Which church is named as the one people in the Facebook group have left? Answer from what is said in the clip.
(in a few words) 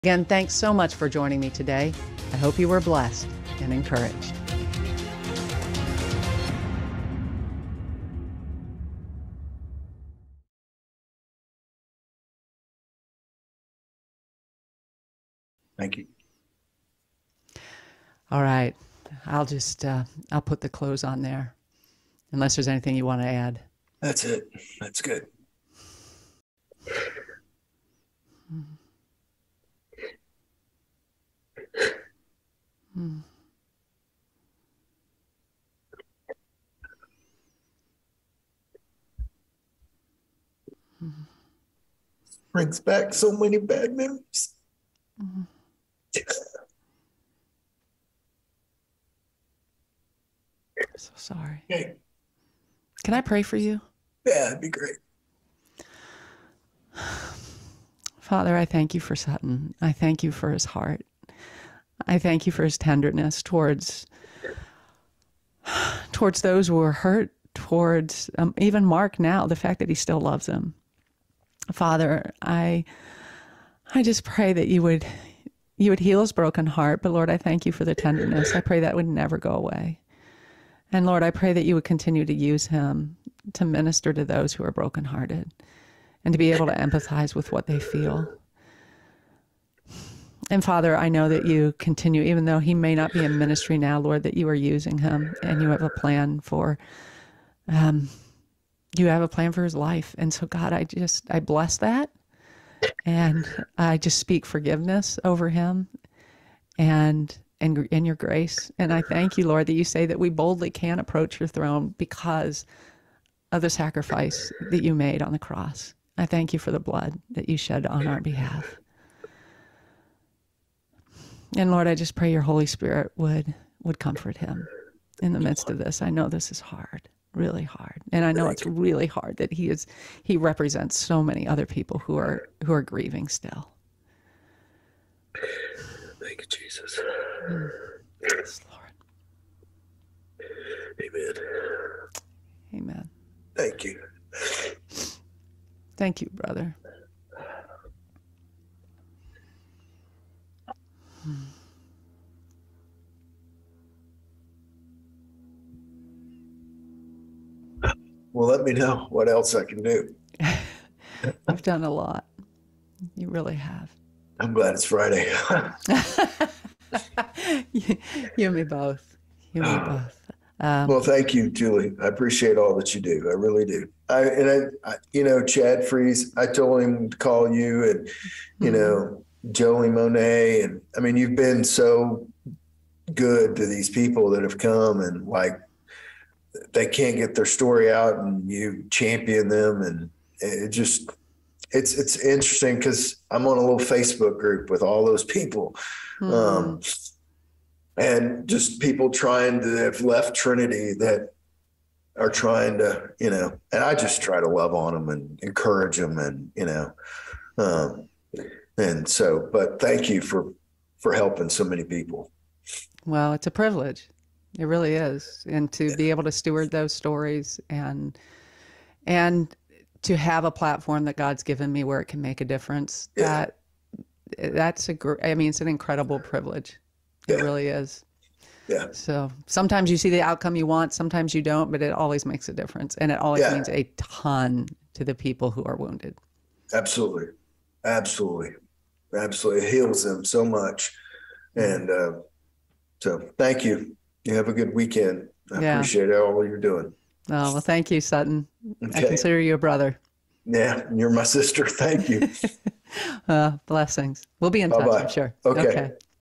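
Trinity.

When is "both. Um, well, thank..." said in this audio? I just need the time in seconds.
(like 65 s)
170 s.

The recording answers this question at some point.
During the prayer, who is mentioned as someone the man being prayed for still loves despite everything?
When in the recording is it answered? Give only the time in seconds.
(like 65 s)
68 s.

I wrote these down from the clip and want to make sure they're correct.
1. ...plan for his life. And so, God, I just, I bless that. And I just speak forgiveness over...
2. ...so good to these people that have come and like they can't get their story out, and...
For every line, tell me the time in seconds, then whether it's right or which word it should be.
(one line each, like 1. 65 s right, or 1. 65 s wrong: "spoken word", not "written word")
1. 99 s right
2. 181 s right.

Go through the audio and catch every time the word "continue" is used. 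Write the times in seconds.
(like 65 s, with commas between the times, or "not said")
81 s, 91 s.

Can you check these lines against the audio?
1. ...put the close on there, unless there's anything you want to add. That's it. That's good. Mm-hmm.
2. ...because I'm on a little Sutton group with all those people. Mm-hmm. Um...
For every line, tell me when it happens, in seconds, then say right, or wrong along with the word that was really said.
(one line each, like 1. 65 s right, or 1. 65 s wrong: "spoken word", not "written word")
1. 20 s right
2. 192 s wrong: "Facebook", not "Sutton".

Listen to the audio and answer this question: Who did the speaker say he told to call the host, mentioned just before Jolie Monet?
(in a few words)
Chad Freeze.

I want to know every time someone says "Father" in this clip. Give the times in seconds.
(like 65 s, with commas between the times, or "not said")
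58 s, 71 s, 90 s.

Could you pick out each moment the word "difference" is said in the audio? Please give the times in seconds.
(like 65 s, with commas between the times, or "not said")
222 s, 232 s.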